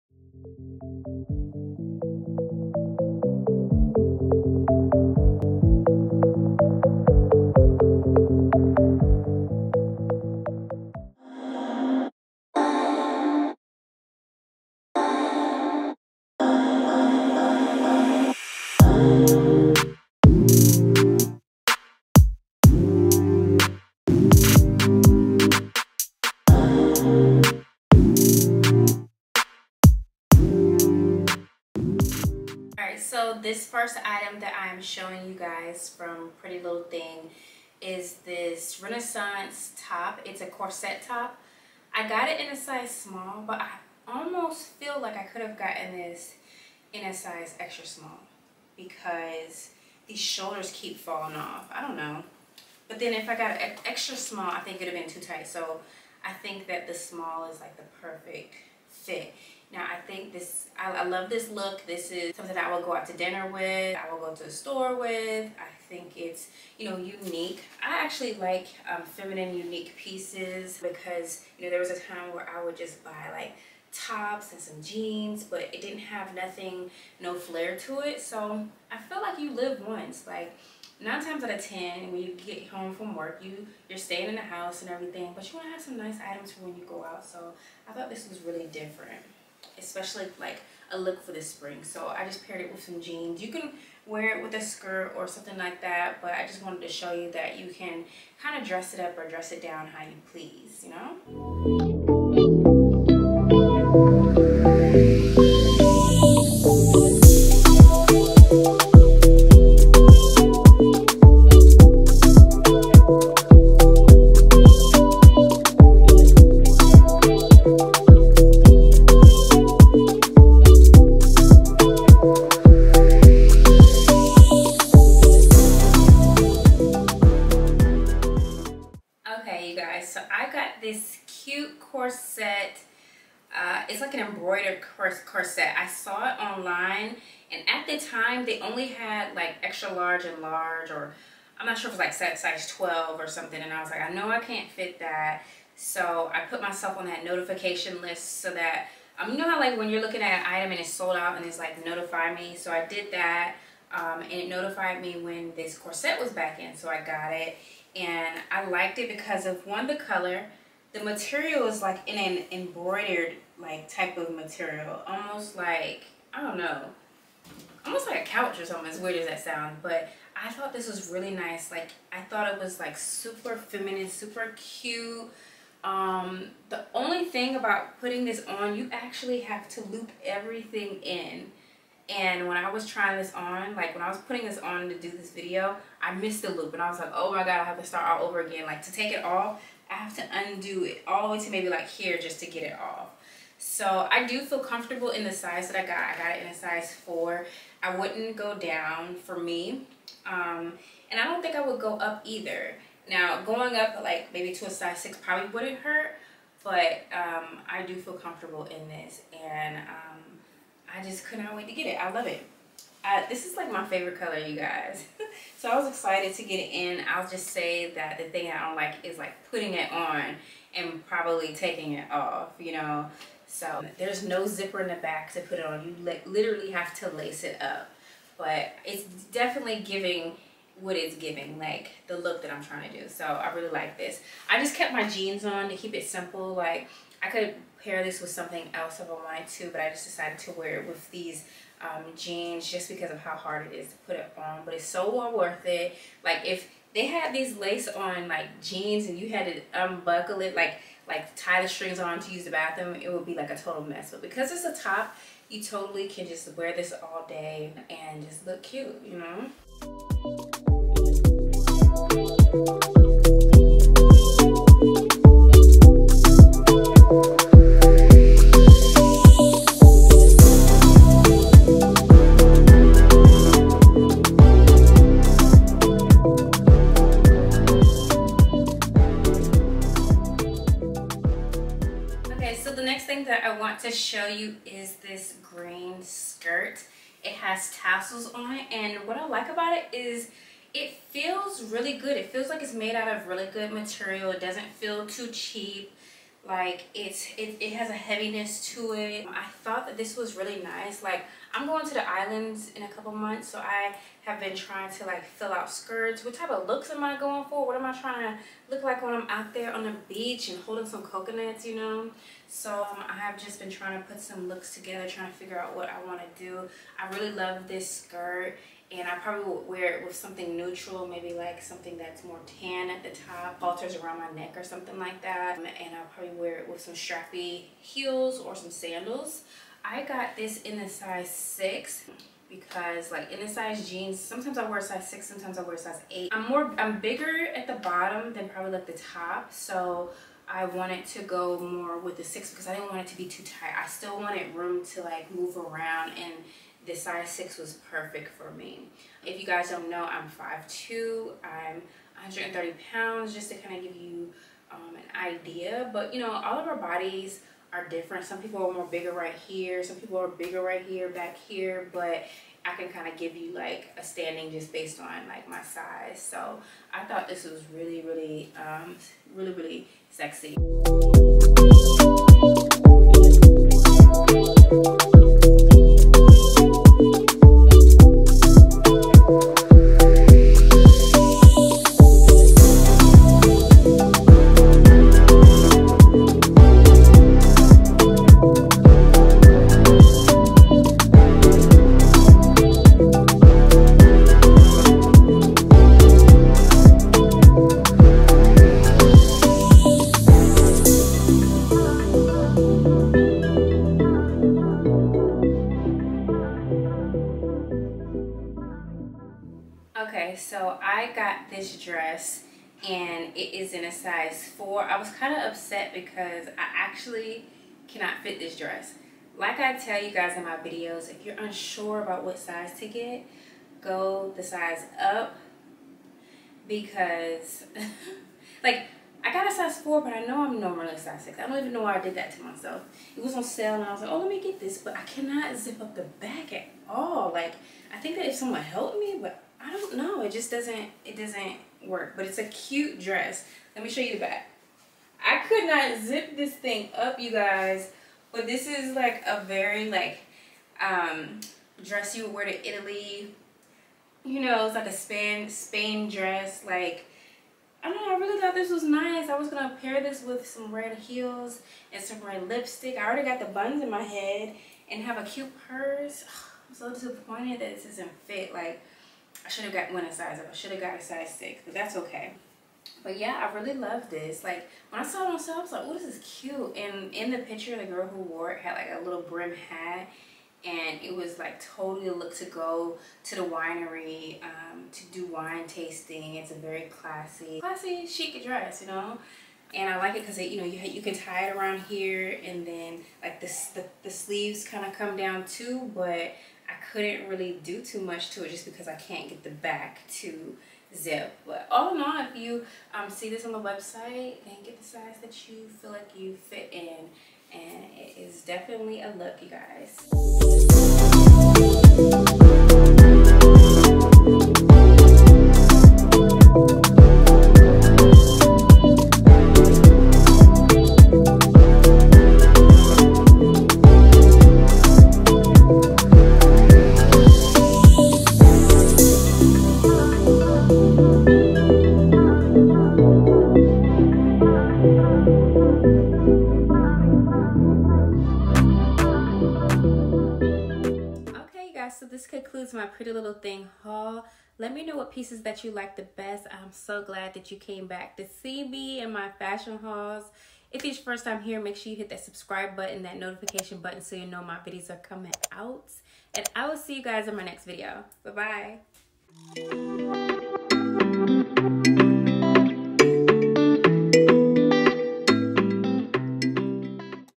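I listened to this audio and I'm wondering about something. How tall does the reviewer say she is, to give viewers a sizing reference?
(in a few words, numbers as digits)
5'2.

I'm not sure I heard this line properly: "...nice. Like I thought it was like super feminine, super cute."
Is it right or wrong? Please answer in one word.
right.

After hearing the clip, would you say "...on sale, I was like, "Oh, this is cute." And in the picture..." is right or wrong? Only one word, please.
right.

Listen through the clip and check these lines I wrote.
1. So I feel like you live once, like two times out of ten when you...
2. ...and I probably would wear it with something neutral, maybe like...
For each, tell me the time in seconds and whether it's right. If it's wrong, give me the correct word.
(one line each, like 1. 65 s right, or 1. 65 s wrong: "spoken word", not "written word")
1. 78 s wrong: "nine", not "two"
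2. 318 s right.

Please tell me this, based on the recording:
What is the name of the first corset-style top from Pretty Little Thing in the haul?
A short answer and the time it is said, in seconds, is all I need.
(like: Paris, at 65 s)
Renaissance, at 38 s.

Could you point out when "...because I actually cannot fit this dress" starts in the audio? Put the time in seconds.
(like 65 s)
415 s.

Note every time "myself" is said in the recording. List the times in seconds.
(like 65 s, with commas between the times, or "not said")
146 s, 432 s.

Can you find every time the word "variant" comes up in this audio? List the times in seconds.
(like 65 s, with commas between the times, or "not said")
not said.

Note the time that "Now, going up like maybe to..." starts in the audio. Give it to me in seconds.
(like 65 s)
203 s.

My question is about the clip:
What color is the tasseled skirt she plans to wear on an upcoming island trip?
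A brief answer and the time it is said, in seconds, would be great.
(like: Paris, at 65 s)
green, at 285 s.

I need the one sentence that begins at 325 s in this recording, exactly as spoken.
Um, and I'll probably wear it with some strappy heels or some sandals.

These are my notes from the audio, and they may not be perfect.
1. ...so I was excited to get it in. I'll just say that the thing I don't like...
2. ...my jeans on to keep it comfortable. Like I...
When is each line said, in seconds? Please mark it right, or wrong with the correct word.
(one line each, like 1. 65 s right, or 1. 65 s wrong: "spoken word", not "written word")
1. 215 s right
2. 234 s wrong: "simple", not "comfortable".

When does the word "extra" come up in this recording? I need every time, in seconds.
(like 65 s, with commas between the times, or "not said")
47 s, 53 s, 139 s.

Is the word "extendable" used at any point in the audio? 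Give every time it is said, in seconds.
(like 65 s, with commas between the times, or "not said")
not said.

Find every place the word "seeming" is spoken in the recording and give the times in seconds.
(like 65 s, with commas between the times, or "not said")
not said.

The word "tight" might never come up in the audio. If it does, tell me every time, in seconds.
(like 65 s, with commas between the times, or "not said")
55 s, 343 s.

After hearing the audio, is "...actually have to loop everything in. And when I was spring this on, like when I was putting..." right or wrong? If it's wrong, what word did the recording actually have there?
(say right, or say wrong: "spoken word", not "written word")
wrong: "trying", not "spring".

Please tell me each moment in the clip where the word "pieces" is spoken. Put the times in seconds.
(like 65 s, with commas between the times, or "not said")
69 s, 545 s.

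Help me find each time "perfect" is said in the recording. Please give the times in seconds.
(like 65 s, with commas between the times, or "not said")
58 s, 347 s.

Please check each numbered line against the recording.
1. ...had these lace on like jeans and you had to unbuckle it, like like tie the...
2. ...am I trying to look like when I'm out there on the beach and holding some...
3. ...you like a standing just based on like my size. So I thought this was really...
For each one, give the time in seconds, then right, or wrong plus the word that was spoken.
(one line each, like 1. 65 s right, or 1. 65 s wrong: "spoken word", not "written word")
1. 247 s right
2. 307 s right
3. 363 s right.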